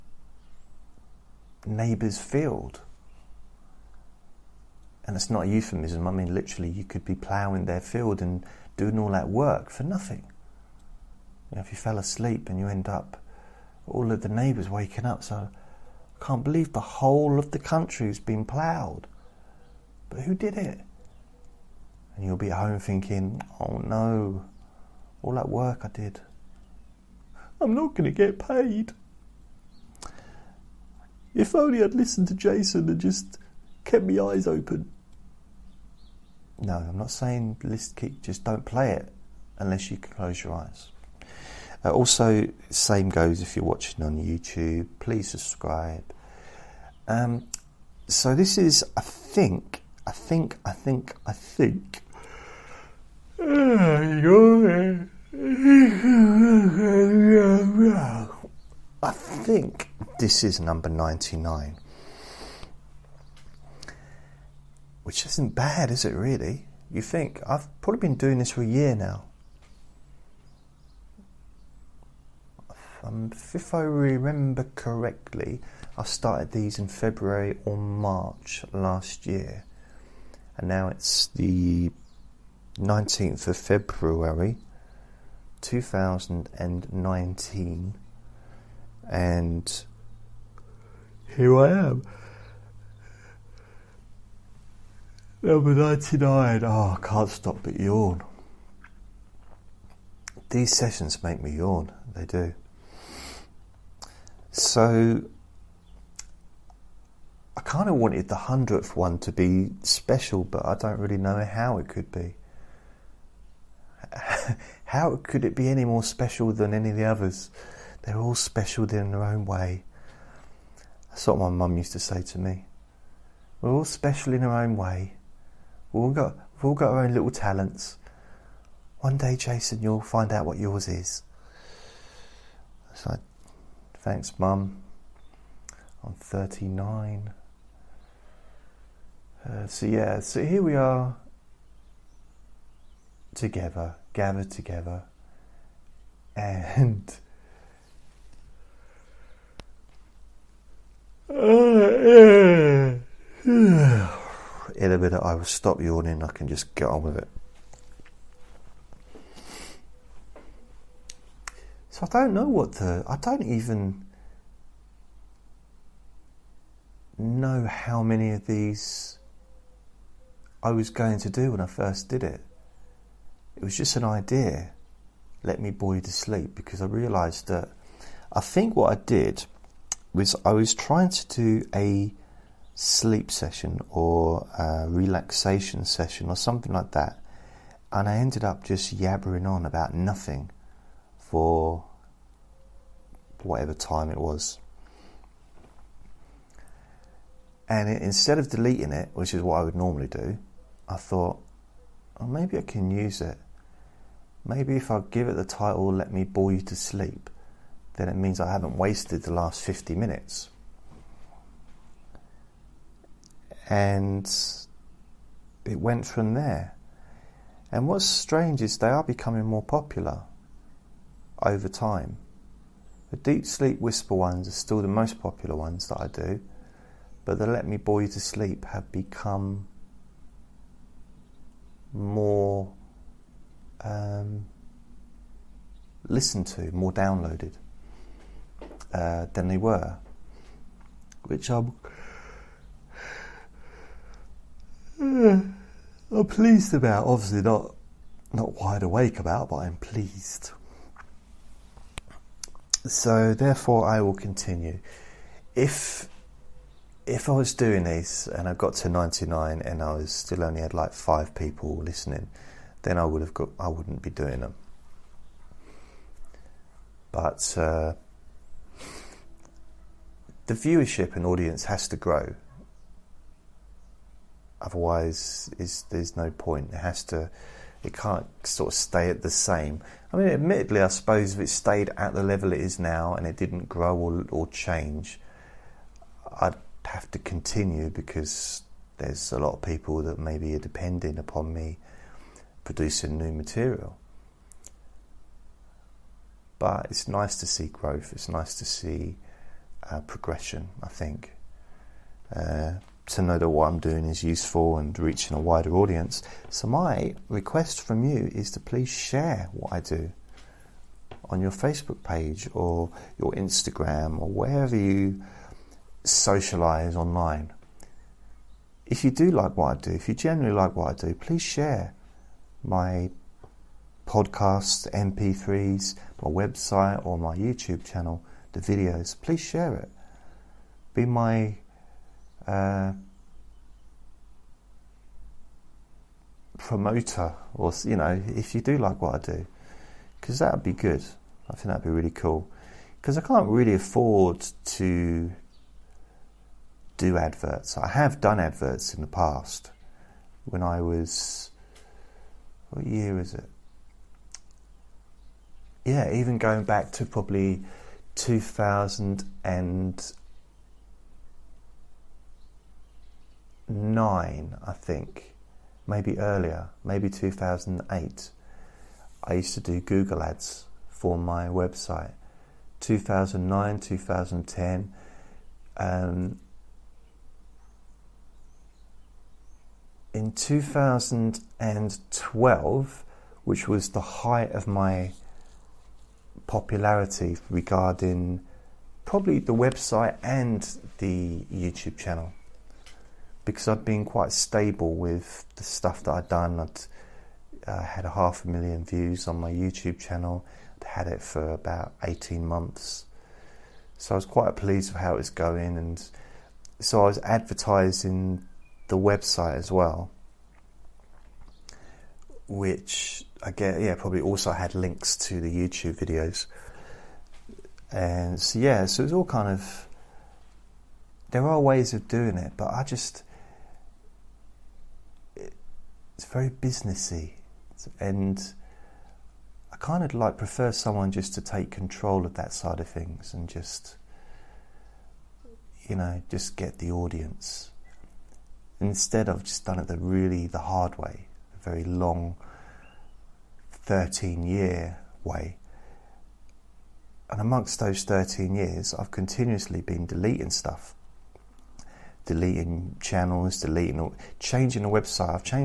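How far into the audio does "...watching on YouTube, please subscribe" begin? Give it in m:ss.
0:43.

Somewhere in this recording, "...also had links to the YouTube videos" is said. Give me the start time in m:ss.
6:54.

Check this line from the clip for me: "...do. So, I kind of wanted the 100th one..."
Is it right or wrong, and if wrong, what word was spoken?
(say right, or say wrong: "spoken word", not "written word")
right.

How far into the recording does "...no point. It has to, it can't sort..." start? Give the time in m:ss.
4:36.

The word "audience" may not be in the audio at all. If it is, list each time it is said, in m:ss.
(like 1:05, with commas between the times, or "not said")
4:31, 5:05, 7:16.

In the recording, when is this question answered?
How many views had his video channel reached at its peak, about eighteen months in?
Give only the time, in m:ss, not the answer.
6:38.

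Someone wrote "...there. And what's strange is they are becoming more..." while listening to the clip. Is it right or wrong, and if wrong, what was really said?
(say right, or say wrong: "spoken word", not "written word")
right.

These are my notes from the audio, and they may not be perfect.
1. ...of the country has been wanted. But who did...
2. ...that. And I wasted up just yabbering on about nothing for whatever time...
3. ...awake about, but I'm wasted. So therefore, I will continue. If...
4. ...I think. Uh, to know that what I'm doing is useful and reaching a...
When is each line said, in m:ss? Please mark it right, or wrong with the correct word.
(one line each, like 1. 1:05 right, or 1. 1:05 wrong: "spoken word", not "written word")
1. 0:17 wrong: "ploughed", not "wanted"
2. 3:06 wrong: "ended", not "wasted"
3. 4:08 wrong: "pleased", not "wasted"
4. 5:00 right.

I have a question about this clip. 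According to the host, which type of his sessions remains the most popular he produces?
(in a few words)
deep sleep whisper.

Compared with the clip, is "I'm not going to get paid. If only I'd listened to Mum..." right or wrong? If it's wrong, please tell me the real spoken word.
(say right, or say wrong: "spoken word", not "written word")
wrong: "Jason", not "Mum".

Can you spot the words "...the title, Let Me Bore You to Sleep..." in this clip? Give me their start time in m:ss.
3:25.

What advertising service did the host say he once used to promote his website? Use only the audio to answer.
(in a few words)
Google Ads.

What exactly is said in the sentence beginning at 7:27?
And amongst those 13 years, I've continuously been deleting stuff deleting channels, deleting, changing the website.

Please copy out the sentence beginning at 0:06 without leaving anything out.
I mean, literally, you could be ploughing their field and doing all that work for nothing.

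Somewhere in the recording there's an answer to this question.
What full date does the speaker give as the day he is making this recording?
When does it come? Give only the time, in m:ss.
1:22.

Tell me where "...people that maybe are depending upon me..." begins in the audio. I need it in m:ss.
4:49.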